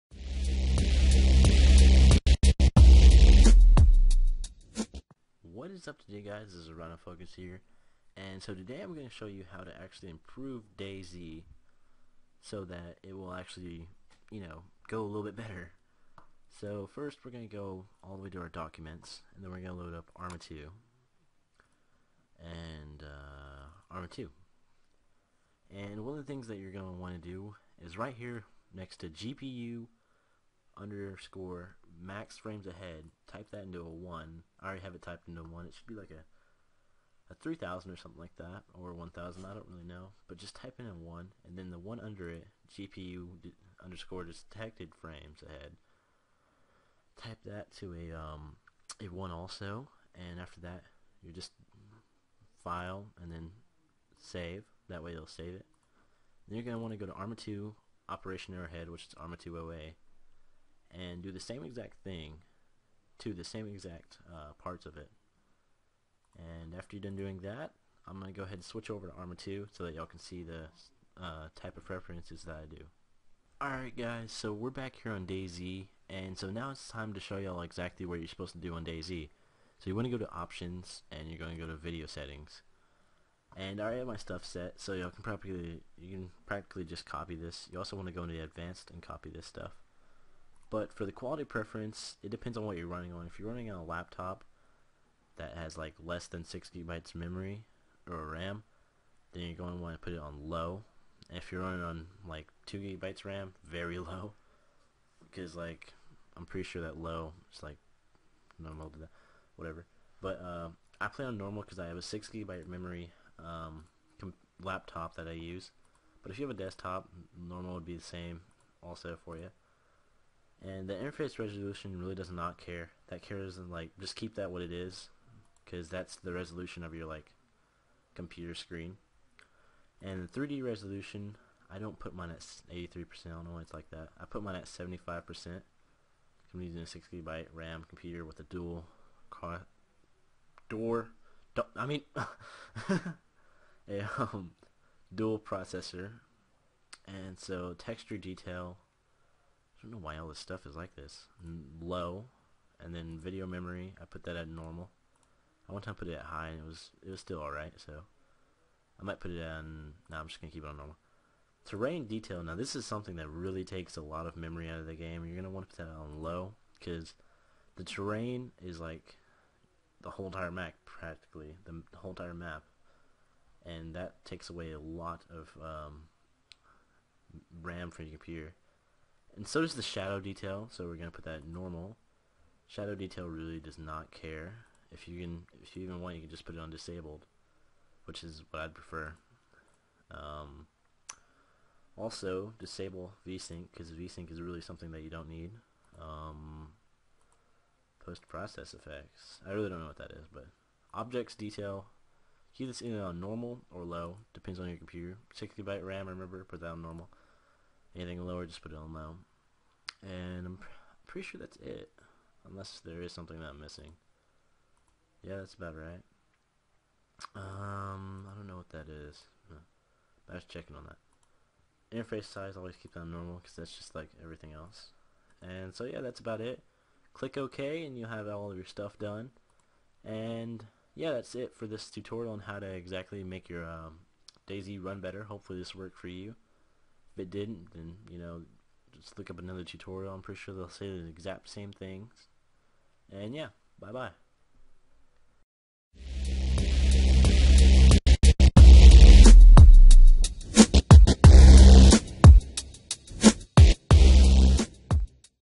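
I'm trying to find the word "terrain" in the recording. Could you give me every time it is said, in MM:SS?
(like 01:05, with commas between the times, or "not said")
02:41, 02:47.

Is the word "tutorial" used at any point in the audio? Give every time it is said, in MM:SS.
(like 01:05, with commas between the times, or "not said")
03:51, 03:59.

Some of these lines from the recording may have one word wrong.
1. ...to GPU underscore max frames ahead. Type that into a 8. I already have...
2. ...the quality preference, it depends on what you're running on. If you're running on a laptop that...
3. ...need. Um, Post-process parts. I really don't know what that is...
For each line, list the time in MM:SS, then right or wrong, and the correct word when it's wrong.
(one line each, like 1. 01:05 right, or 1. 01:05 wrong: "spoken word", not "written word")
1. 00:28 wrong: "1", not "8"
2. 01:31 right
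3. 03:15 wrong: "effects", not "parts".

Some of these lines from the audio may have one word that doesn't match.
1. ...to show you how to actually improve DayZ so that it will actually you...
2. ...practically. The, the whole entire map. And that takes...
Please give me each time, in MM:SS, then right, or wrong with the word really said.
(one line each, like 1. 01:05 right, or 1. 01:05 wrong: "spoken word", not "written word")
1. 00:09 right
2. 02:50 right.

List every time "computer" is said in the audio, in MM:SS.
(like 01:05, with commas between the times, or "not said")
02:08, 02:17, 02:58, 03:24.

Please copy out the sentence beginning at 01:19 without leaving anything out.
So you want to go to options, and you're going to go to video settings.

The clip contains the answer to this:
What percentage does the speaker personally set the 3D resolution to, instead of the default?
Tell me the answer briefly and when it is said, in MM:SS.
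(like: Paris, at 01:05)
75%, at 02:14.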